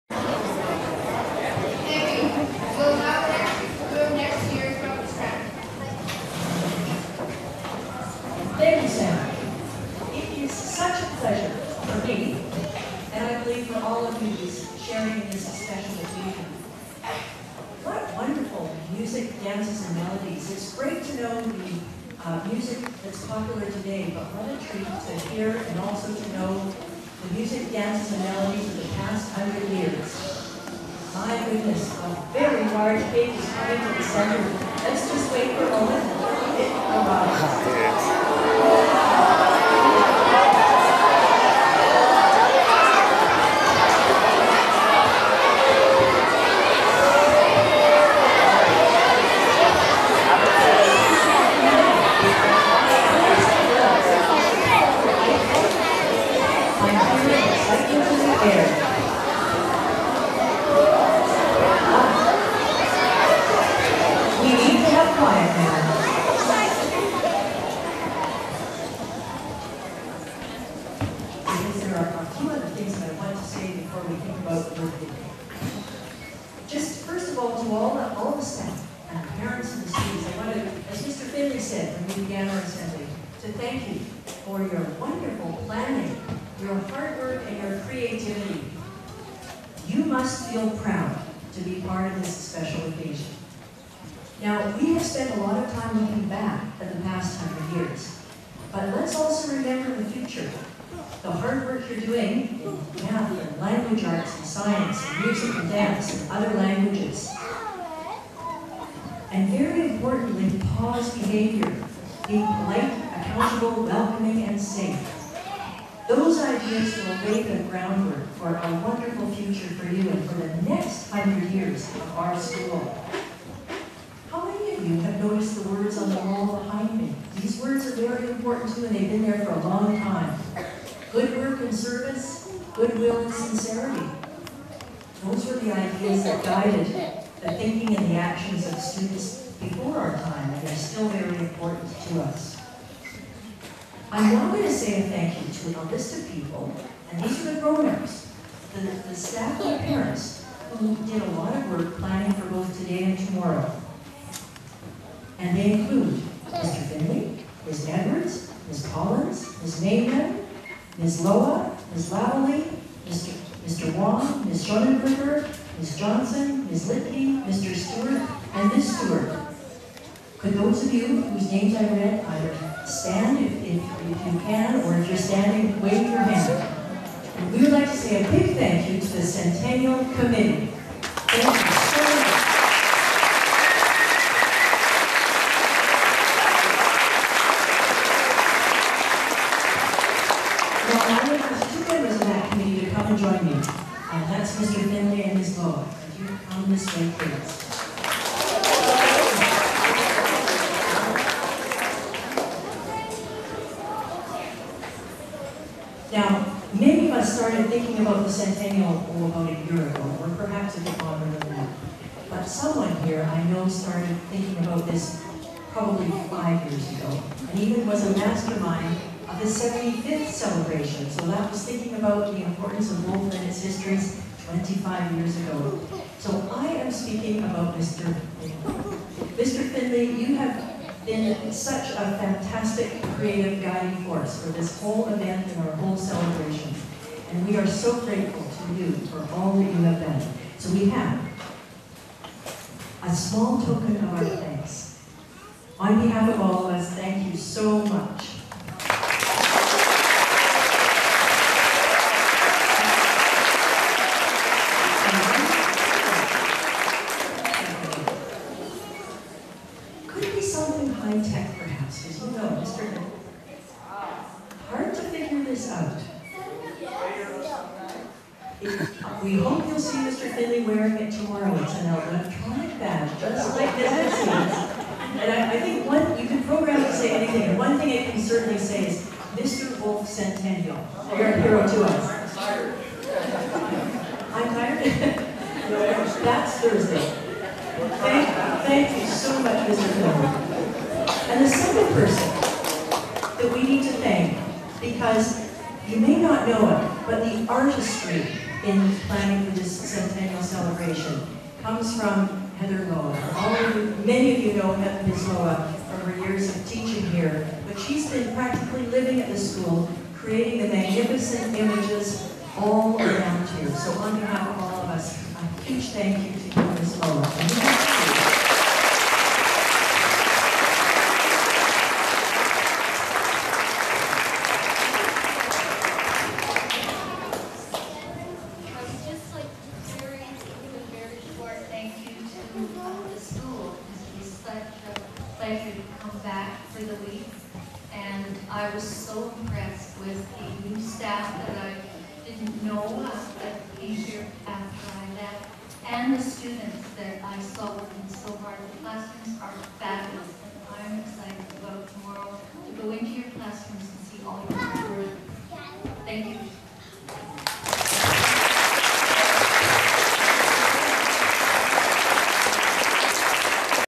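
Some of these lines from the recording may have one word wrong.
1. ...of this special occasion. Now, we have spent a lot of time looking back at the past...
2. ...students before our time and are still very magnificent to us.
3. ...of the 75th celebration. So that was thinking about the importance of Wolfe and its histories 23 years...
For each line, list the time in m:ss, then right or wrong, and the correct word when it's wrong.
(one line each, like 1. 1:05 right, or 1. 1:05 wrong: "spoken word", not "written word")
1. 1:32 right
2. 2:18 wrong: "important", not "magnificent"
3. 3:39 wrong: "25", not "23".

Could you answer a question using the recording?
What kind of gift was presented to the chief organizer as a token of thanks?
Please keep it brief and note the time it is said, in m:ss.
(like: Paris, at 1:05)
electronic badge, at 4:31.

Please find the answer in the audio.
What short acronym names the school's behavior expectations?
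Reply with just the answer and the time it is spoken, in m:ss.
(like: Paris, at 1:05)
PAWS, at 1:50.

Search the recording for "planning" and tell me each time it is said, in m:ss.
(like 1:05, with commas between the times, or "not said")
2:31, 4:59.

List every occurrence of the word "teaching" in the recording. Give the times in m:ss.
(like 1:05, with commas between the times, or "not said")
5:06.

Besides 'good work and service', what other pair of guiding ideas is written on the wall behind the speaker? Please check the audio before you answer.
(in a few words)
goodwill and sincerity.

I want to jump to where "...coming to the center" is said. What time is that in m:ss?
0:33.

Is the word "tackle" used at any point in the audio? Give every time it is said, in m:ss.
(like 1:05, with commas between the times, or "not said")
not said.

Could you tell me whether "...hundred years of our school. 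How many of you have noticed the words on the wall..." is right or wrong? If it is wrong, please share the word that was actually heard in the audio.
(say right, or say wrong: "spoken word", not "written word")
right.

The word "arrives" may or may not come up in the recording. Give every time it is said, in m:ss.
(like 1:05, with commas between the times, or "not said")
0:36.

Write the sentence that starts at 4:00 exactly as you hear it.
So we have a small token of our thanks.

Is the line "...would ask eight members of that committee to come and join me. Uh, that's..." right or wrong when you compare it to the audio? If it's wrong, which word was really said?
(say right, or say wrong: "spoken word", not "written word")
wrong: "two", not "eight".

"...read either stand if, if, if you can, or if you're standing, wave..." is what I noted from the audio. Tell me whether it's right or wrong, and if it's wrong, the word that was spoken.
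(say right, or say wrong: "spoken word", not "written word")
right.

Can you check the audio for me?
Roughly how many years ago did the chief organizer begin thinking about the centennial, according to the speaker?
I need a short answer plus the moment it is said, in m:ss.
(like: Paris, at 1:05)
5 years, at 3:36.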